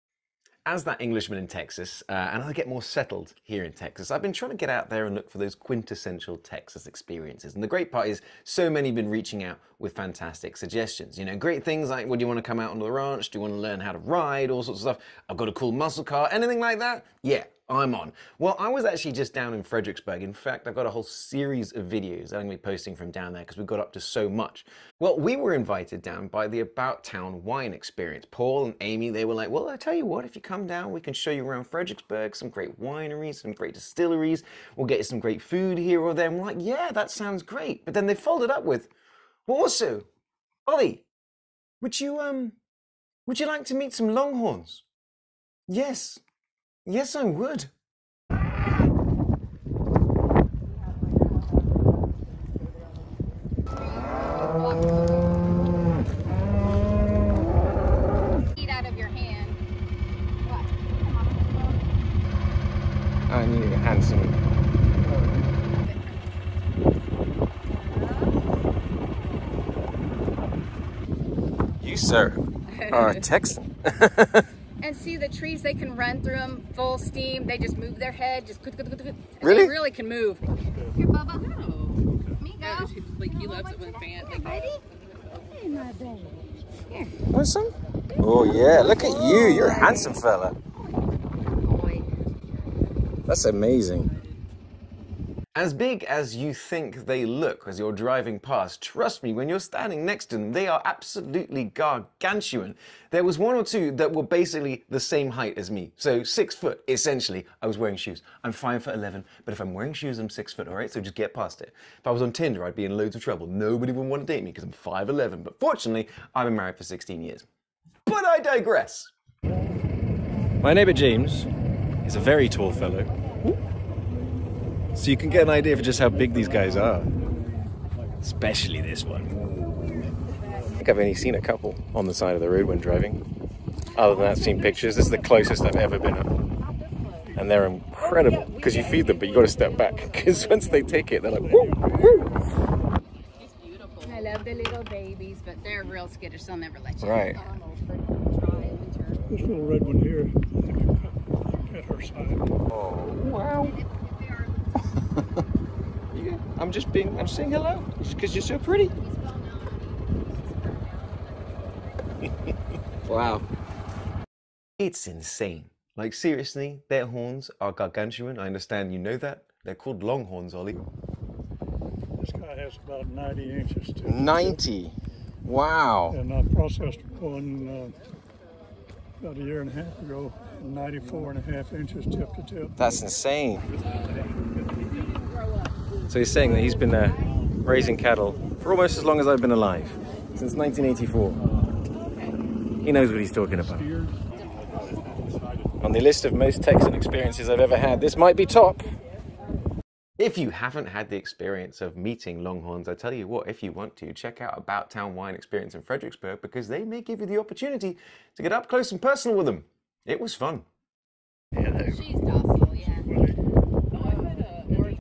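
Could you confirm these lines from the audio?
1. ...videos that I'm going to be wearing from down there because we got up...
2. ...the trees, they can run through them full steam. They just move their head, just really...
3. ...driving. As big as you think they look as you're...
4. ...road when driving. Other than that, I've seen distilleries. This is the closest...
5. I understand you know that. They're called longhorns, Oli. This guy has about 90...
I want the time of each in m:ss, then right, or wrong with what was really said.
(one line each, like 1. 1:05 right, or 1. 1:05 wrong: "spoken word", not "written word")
1. 0:21 wrong: "posting", not "wearing"
2. 1:15 right
3. 1:33 wrong: "amazing", not "driving"
4. 2:12 wrong: "pictures", not "distilleries"
5. 2:48 right.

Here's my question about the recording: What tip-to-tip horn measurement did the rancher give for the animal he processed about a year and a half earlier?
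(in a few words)
94.5 inches.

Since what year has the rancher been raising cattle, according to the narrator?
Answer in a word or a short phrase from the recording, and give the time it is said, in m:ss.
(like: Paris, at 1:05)
1984, at 3:10.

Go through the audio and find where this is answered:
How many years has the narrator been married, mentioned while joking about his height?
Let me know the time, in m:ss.
1:56.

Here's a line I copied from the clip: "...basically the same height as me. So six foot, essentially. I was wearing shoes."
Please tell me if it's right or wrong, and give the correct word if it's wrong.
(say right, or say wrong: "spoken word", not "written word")
right.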